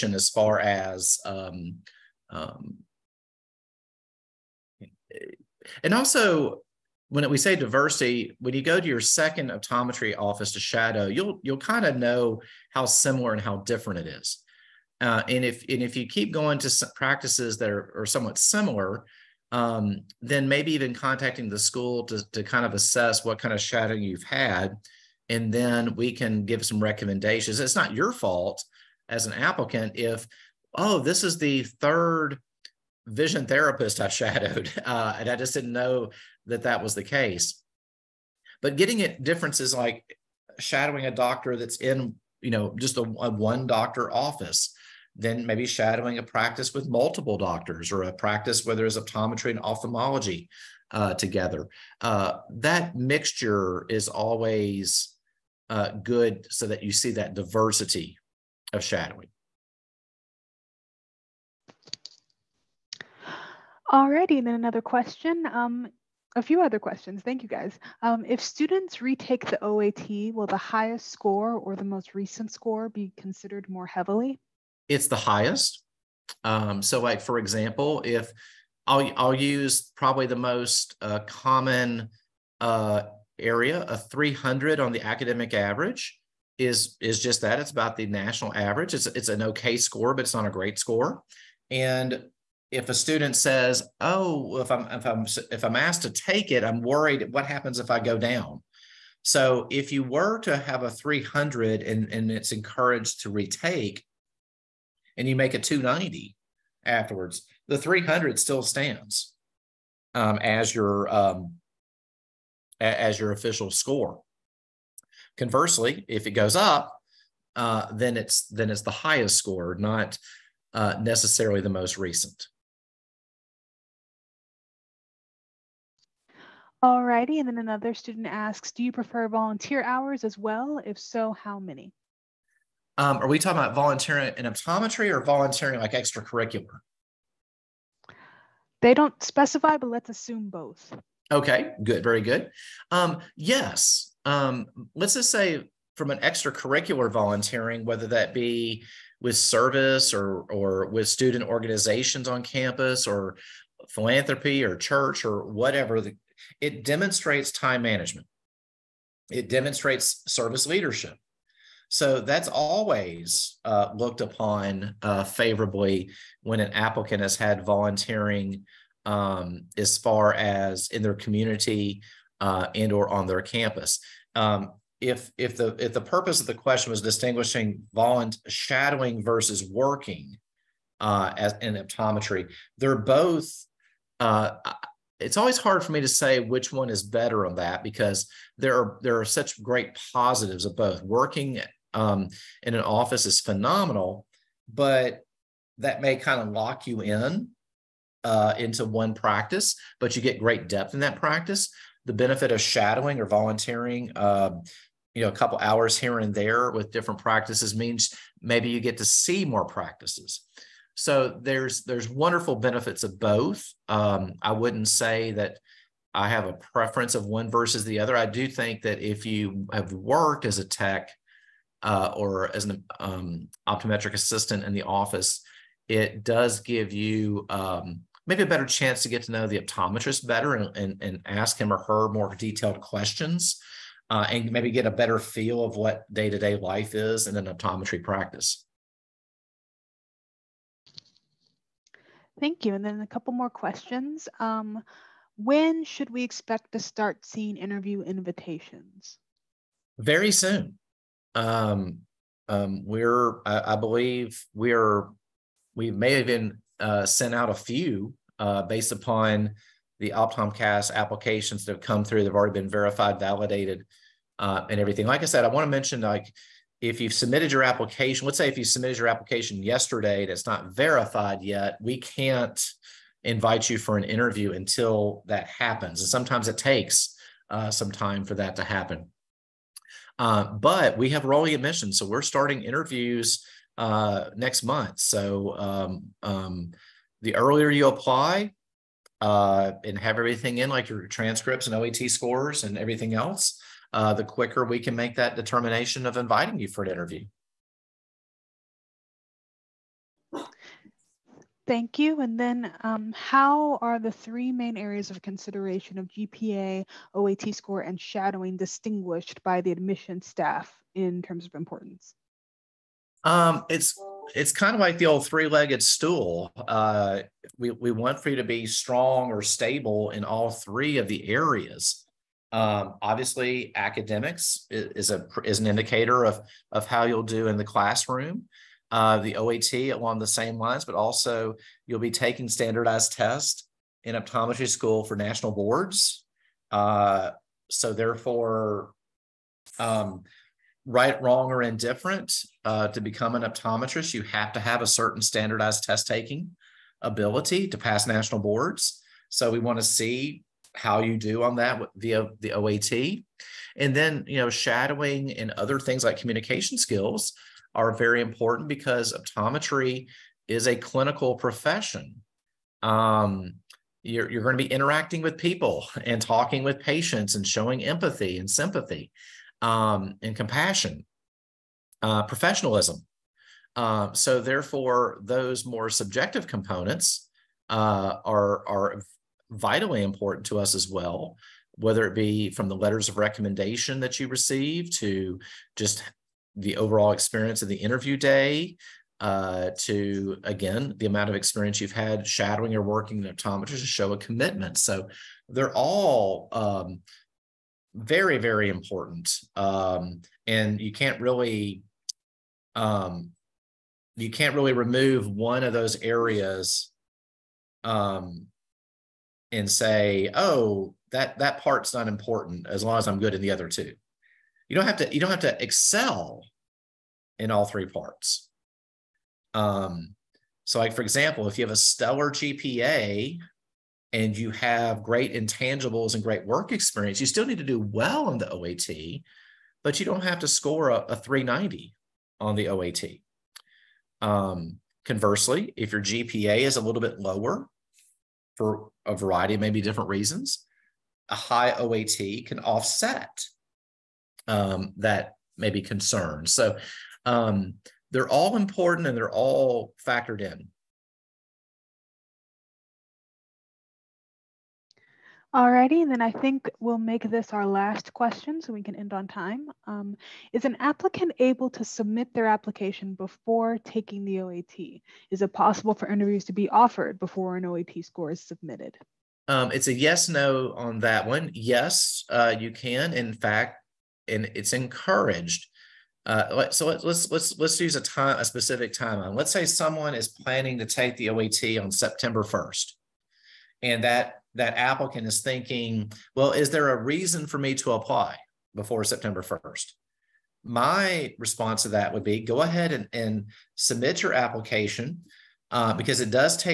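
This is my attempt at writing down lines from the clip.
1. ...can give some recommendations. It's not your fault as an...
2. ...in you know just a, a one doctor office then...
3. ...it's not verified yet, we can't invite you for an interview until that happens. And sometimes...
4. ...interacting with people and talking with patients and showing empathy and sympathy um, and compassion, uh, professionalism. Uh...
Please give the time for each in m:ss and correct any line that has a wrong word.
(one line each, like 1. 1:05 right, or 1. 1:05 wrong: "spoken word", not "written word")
1. 0:26 right
2. 0:41 right
3. 4:30 right
4. 6:04 right.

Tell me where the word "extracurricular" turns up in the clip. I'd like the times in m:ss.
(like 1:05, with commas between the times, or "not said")
2:15, 2:26.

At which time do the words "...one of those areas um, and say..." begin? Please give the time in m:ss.
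6:45.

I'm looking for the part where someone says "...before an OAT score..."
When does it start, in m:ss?
7:47.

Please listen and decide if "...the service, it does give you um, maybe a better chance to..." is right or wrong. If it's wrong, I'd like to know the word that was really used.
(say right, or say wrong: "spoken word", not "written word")
wrong: "office", not "service".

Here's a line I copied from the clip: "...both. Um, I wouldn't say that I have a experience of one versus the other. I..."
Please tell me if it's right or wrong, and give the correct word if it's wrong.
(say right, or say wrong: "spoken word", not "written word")
wrong: "preference", not "experience".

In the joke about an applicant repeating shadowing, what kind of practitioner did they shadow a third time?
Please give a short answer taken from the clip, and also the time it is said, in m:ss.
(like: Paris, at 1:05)
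vision therapist, at 0:33.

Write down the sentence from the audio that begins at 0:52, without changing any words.
Uh, that mixture is always uh, good so that you see that diversity of shadowing.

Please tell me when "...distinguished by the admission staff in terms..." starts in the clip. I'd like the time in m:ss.
5:08.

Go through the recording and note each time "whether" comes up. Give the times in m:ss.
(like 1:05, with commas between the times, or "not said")
2:27, 6:21.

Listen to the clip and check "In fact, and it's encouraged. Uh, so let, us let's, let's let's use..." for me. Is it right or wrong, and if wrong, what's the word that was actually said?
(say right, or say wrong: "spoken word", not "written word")
right.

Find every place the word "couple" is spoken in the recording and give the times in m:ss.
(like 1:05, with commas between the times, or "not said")
3:25, 4:03.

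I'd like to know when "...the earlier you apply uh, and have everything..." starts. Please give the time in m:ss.
4:47.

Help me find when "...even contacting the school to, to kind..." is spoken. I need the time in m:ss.
0:20.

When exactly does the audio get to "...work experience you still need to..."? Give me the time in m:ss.
7:06.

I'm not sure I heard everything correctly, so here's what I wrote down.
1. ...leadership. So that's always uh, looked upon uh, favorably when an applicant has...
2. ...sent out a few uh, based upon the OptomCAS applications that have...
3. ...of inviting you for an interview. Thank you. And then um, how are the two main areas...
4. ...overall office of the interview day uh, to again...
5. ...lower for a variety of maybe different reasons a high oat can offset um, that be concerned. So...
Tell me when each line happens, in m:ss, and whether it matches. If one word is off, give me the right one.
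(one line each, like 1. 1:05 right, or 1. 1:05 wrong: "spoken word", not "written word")
1. 2:40 right
2. 4:17 right
3. 4:56 wrong: "three", not "two"
4. 6:26 wrong: "experience", not "office"
5. 7:17 right.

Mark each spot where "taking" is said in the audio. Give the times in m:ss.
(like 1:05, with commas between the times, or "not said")
5:32, 5:46, 7:43.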